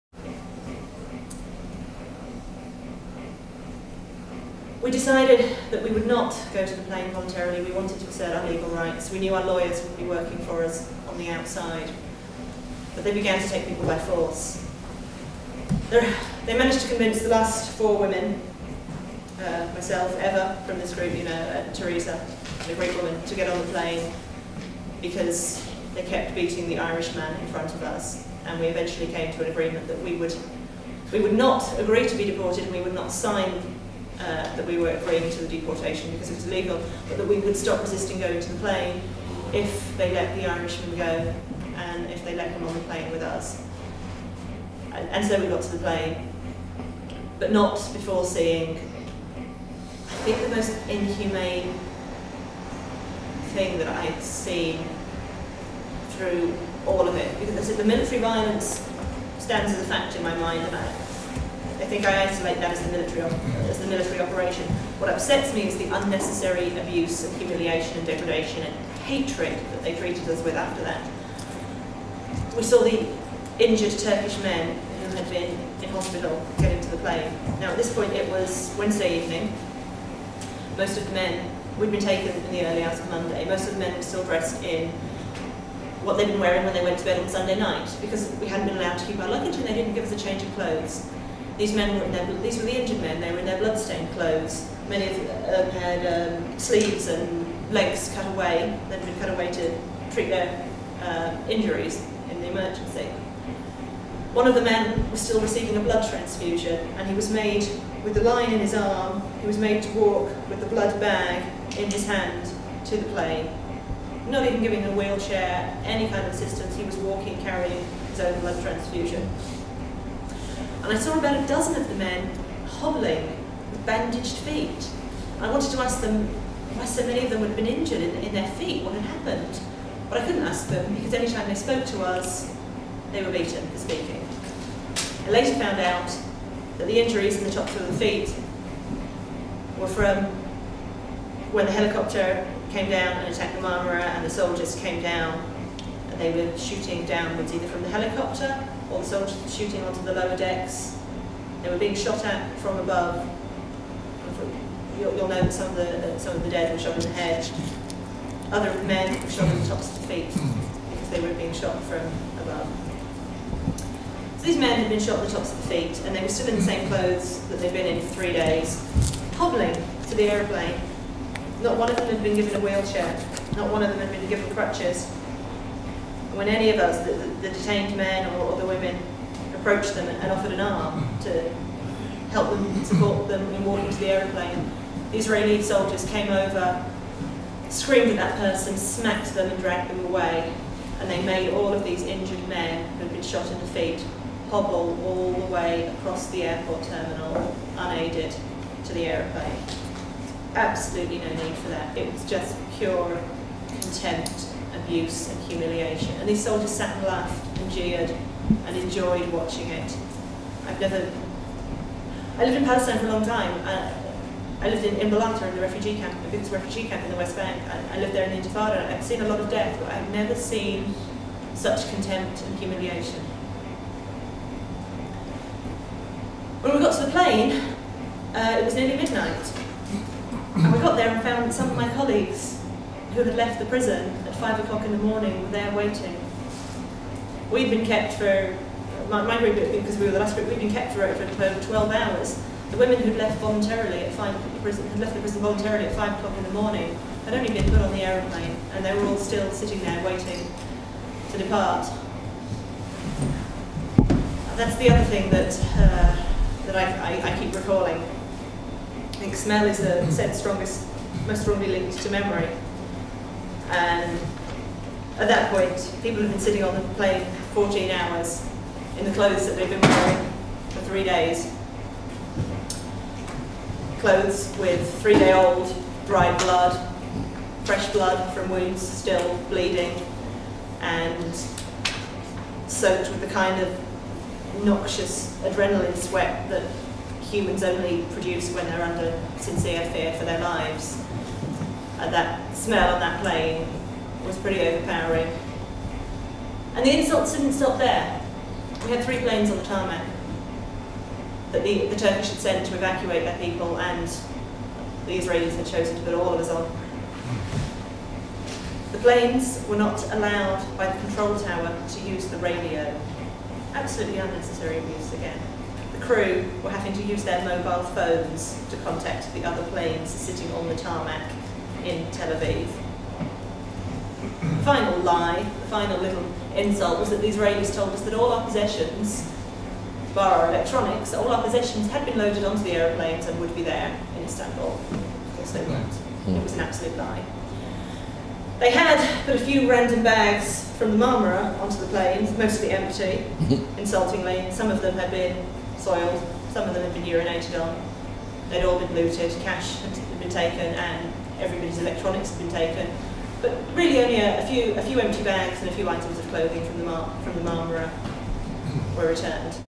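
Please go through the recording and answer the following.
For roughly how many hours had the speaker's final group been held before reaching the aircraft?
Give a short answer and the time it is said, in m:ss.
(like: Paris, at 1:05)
12, at 4:01.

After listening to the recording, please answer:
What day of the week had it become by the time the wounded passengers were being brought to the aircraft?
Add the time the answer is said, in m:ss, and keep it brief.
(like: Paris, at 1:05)
Wednesday, at 1:18.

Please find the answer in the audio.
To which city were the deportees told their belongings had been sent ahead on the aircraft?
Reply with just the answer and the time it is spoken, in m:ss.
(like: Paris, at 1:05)
Istanbul, at 5:34.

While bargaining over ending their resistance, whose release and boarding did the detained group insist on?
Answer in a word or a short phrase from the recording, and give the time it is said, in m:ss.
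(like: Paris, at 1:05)
The Irishman, at 0:40.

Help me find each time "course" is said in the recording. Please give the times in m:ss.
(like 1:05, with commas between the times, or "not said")
5:35.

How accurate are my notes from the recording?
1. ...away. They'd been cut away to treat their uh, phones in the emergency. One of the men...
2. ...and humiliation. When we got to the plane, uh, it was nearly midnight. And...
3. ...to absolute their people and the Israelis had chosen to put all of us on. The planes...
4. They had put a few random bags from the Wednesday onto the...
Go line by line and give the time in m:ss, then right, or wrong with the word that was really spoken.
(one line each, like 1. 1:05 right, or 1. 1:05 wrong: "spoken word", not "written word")
1. 1:38 wrong: "injuries", not "phones"
2. 3:42 right
3. 5:02 wrong: "evacuate", not "absolute"
4. 5:38 wrong: "Marmara", not "Wednesday".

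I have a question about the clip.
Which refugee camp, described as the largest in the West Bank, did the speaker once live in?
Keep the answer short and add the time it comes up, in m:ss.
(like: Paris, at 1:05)
Imbalata, at 3:34.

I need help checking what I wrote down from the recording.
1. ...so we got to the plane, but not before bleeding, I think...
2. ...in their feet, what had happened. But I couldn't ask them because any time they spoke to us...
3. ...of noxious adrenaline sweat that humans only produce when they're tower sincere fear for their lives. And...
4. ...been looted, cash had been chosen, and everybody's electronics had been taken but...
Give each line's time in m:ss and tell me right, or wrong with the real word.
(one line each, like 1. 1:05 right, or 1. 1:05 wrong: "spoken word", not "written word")
1. 0:45 wrong: "seeing", not "bleeding"
2. 2:08 right
3. 4:43 wrong: "under", not "tower"
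4. 5:48 wrong: "taken", not "chosen".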